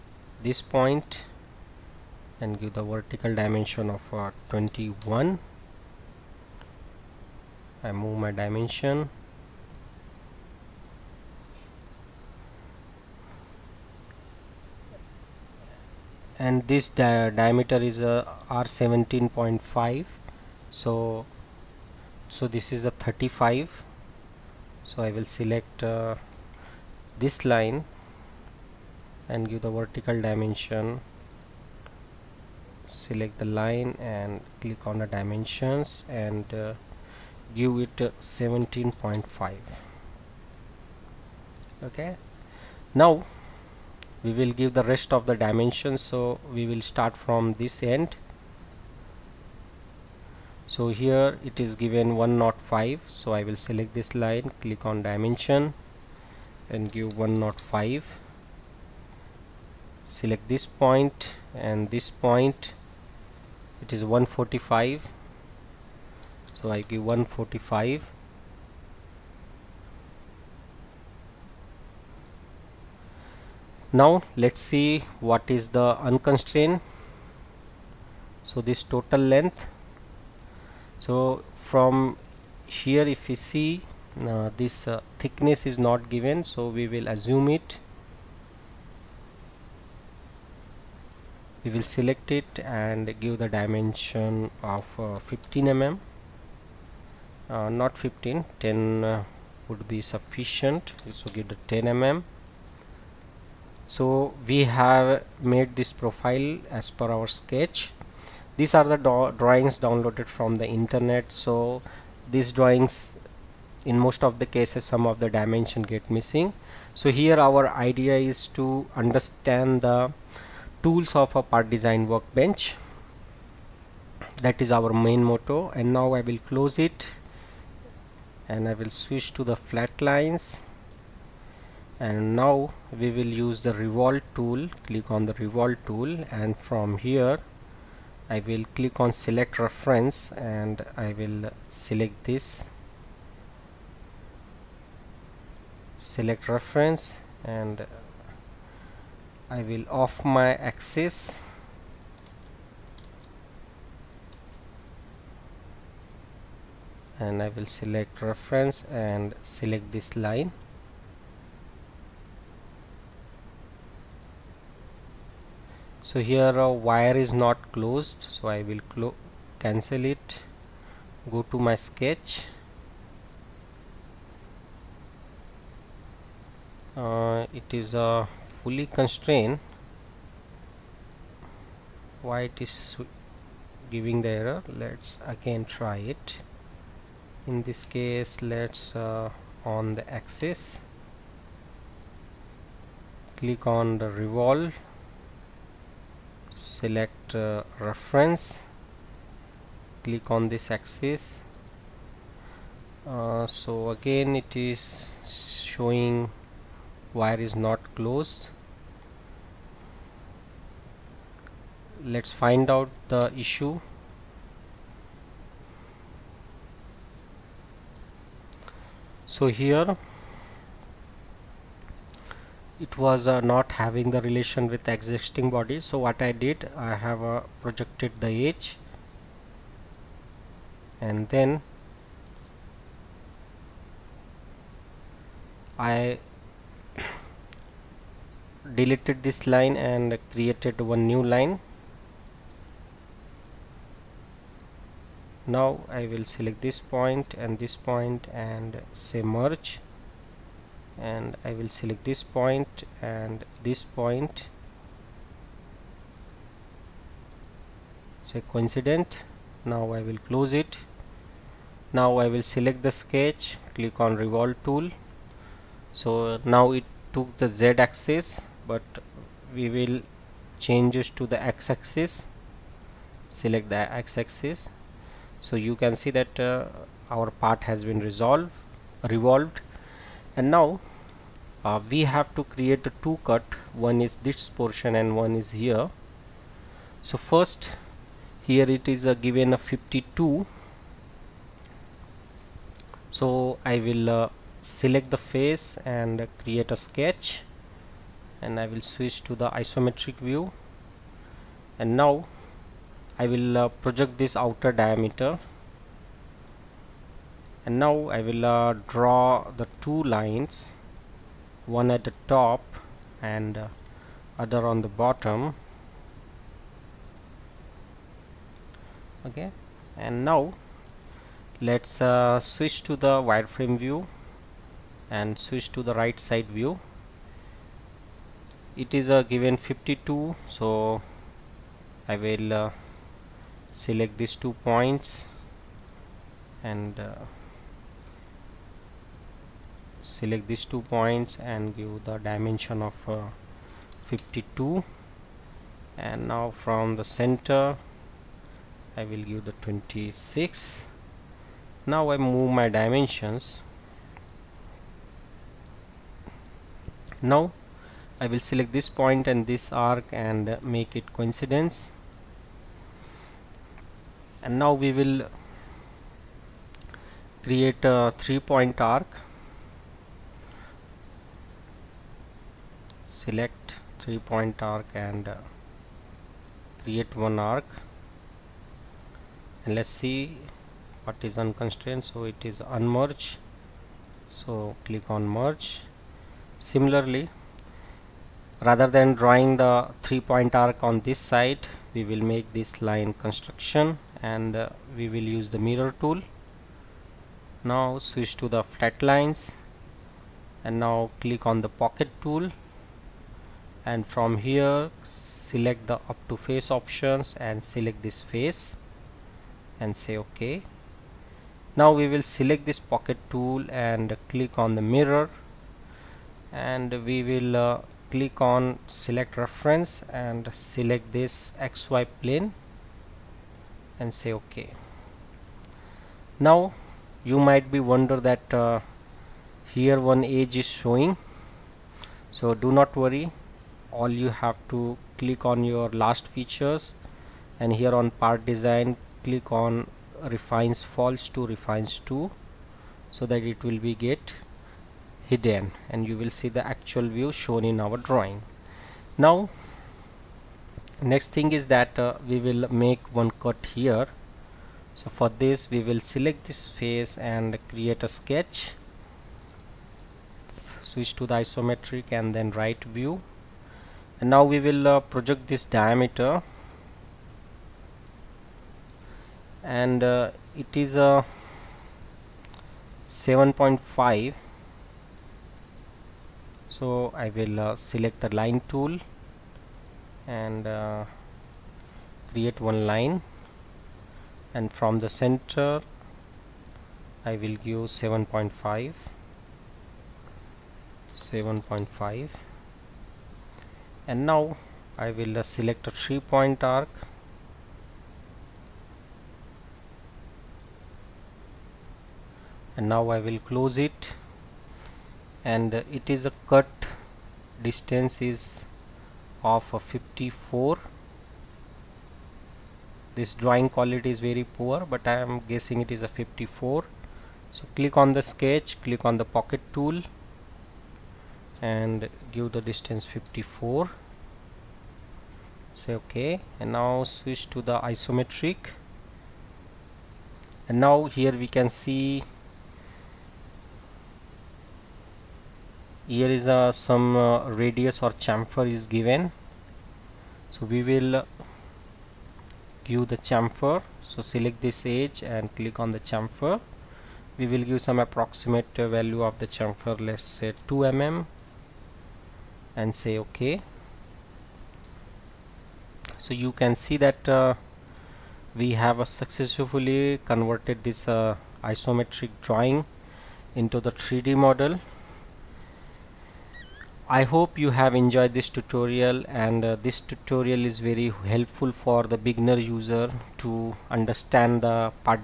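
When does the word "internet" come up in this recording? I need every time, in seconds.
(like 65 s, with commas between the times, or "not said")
110 s.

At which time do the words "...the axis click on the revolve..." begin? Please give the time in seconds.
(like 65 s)
189 s.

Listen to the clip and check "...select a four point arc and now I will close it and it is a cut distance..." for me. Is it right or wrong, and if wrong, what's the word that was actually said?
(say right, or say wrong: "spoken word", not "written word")
wrong: "three", not "four".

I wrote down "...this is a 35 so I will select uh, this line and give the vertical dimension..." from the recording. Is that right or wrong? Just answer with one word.
right.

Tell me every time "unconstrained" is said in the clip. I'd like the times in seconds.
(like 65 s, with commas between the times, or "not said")
76 s, 381 s.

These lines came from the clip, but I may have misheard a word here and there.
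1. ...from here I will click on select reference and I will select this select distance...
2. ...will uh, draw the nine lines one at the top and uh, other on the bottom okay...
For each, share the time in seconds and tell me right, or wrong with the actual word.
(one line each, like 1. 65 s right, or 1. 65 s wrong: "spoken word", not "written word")
1. 136 s wrong: "reference", not "distance"
2. 308 s wrong: "two", not "nine".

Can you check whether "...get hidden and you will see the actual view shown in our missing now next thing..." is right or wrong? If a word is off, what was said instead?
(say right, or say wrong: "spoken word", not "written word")
wrong: "drawing", not "missing".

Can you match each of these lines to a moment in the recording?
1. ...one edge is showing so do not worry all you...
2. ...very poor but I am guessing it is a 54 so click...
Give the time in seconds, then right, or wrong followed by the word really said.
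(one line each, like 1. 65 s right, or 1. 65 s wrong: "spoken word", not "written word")
1. 430 s right
2. 514 s right.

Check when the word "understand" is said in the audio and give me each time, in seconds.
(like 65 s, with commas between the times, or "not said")
118 s, 573 s.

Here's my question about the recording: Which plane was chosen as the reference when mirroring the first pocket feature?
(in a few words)
xy plane.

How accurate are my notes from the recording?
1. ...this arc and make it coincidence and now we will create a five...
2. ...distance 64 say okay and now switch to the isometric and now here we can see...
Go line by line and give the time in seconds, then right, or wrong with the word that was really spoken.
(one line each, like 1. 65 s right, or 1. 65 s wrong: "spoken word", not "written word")
1. 359 s wrong: "three", not "five"
2. 522 s wrong: "54", not "64".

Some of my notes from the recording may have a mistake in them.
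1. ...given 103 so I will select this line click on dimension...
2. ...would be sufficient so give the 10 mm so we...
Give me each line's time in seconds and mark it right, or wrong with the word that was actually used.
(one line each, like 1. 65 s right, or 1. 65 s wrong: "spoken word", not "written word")
1. 51 s wrong: "105", not "103"
2. 99 s right.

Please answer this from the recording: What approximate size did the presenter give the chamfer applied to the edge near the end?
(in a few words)
2 mm.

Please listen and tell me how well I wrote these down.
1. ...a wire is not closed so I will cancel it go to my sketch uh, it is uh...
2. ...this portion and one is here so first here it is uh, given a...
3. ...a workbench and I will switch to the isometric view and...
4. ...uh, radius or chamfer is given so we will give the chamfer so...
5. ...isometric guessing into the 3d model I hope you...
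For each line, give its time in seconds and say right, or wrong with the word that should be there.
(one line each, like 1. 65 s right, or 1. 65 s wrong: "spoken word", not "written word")
1. 166 s right
2. 284 s right
3. 296 s wrong: "sketch", not "workbench"
4. 537 s right
5. 561 s wrong: "drawing", not "guessing".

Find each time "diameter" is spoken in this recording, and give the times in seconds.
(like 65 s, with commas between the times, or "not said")
17 s, 304 s, 465 s.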